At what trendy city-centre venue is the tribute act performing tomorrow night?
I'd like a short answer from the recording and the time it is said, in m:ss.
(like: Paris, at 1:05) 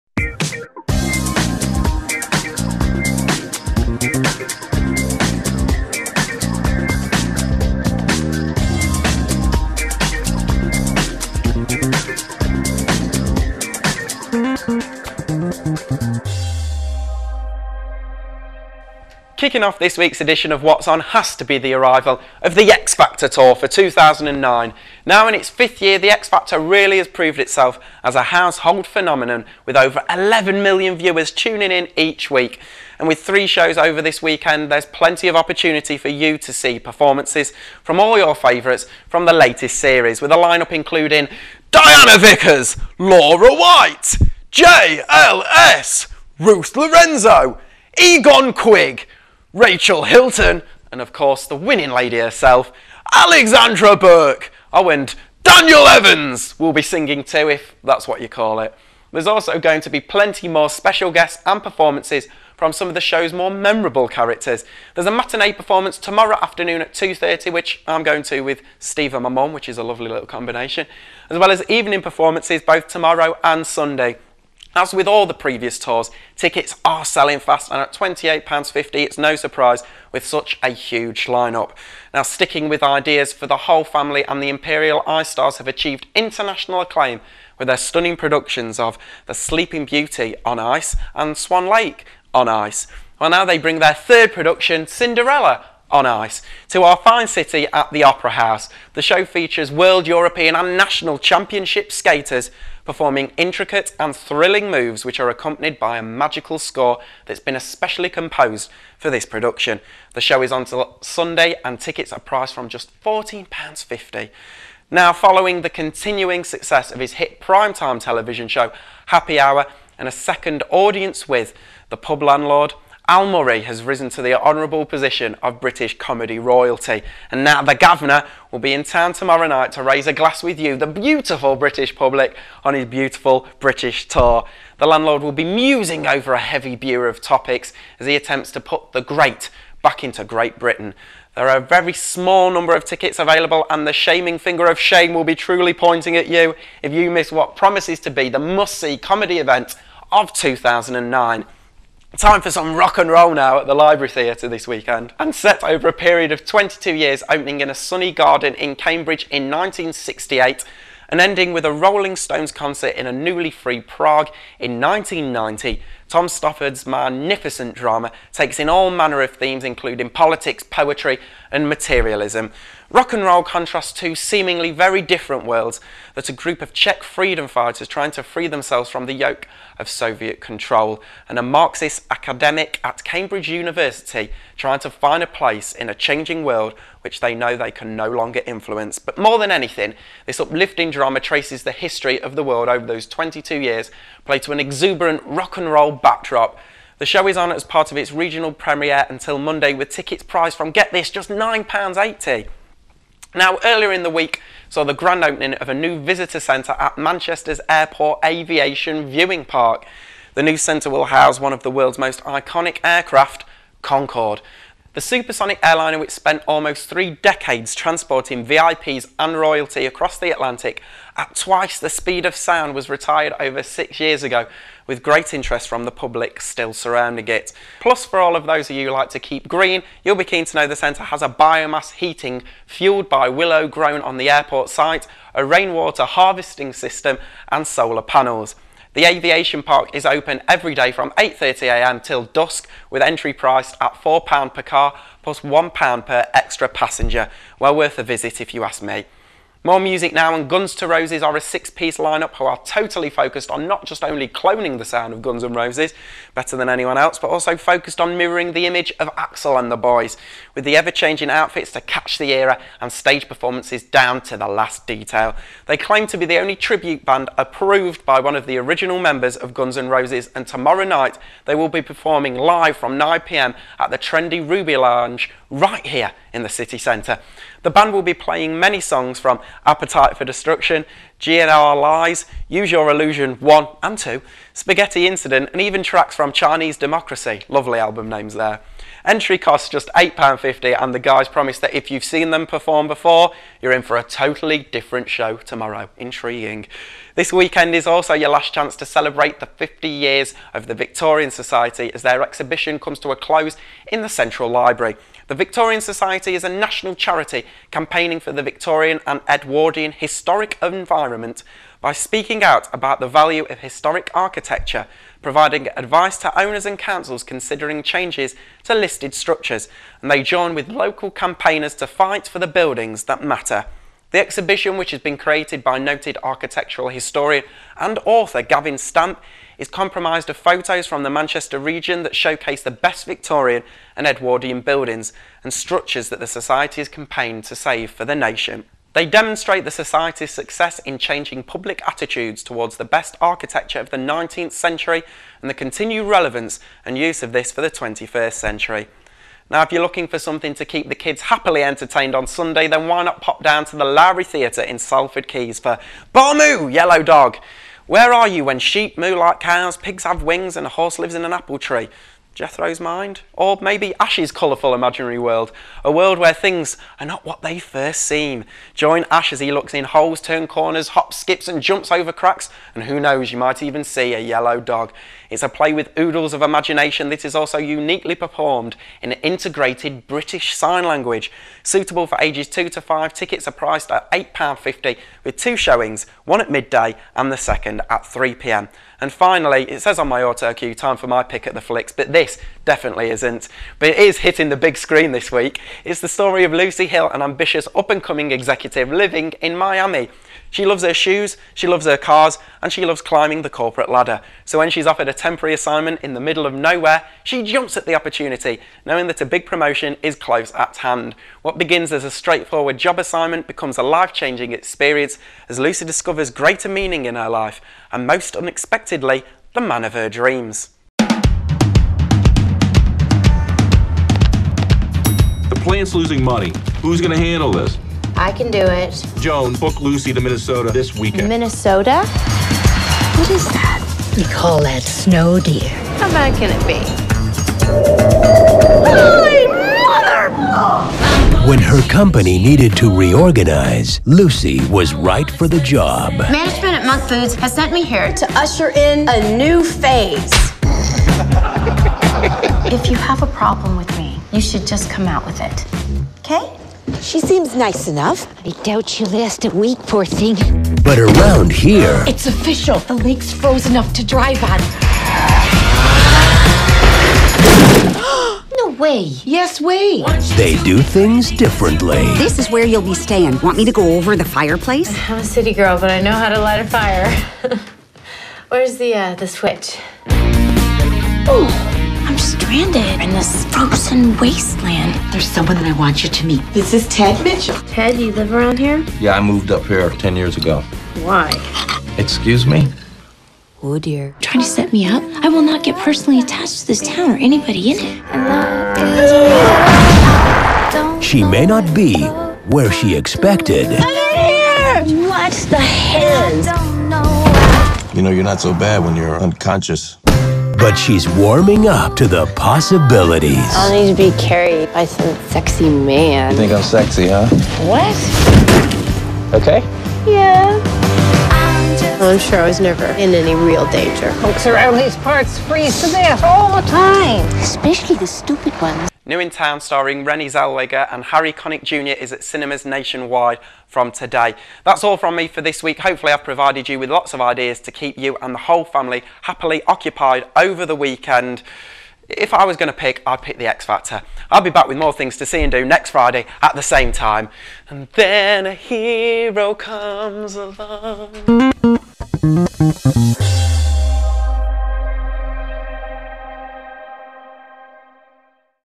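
Ruby Lounge, at 4:34.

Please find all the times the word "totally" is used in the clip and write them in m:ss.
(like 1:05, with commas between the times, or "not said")
4:12, 4:54.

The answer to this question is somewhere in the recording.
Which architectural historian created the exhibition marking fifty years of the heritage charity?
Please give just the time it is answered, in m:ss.
5:28.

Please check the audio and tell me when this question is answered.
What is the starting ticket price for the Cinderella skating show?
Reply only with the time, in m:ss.
1:53.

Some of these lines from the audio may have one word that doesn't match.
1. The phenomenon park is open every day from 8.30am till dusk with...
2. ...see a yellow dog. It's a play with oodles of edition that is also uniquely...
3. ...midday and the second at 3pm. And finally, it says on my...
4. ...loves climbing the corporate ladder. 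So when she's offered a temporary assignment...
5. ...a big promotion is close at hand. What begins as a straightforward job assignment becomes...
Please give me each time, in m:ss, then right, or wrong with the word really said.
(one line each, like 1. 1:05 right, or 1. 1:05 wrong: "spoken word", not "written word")
1. 3:58 wrong: "aviation", not "phenomenon"
2. 6:13 wrong: "imagination", not "edition"
3. 6:26 right
4. 6:42 right
5. 6:49 right.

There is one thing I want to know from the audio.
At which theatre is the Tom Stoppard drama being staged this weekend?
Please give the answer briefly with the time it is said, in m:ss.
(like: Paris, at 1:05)
Library Theatre, at 2:33.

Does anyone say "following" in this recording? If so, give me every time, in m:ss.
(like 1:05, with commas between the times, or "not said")
1:55.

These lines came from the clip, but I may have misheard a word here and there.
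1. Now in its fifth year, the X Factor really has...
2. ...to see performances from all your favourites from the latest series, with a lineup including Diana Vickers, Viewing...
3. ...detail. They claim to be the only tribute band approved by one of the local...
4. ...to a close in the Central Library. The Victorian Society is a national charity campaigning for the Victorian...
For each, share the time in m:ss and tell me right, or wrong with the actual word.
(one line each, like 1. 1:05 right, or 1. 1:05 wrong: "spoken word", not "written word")
1. 0:25 right
2. 0:36 wrong: "Laura", not "Viewing"
3. 4:24 wrong: "original", not "local"
4. 5:02 right.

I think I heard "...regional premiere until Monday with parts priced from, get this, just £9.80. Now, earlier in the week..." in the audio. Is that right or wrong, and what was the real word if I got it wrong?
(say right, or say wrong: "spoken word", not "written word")
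wrong: "tickets", not "parts".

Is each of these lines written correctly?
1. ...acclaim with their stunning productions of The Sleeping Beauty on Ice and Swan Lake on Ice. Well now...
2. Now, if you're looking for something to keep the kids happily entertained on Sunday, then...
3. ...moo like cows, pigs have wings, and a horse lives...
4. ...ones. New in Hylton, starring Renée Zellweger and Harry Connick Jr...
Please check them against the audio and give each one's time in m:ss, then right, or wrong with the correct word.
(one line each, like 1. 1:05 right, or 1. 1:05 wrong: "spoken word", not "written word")
1. 1:26 right
2. 5:49 right
3. 5:58 right
4. 8:48 wrong: "Town", not "Hylton".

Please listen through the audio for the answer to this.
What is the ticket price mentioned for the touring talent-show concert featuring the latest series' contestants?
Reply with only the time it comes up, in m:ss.
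1:17.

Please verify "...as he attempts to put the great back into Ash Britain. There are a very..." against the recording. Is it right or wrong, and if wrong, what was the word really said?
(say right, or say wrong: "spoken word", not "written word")
wrong: "Great", not "Ash".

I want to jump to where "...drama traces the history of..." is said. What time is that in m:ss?
3:10.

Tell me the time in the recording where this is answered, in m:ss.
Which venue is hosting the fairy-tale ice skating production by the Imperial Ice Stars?
1:38.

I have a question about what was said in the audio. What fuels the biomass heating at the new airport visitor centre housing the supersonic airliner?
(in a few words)
Willow.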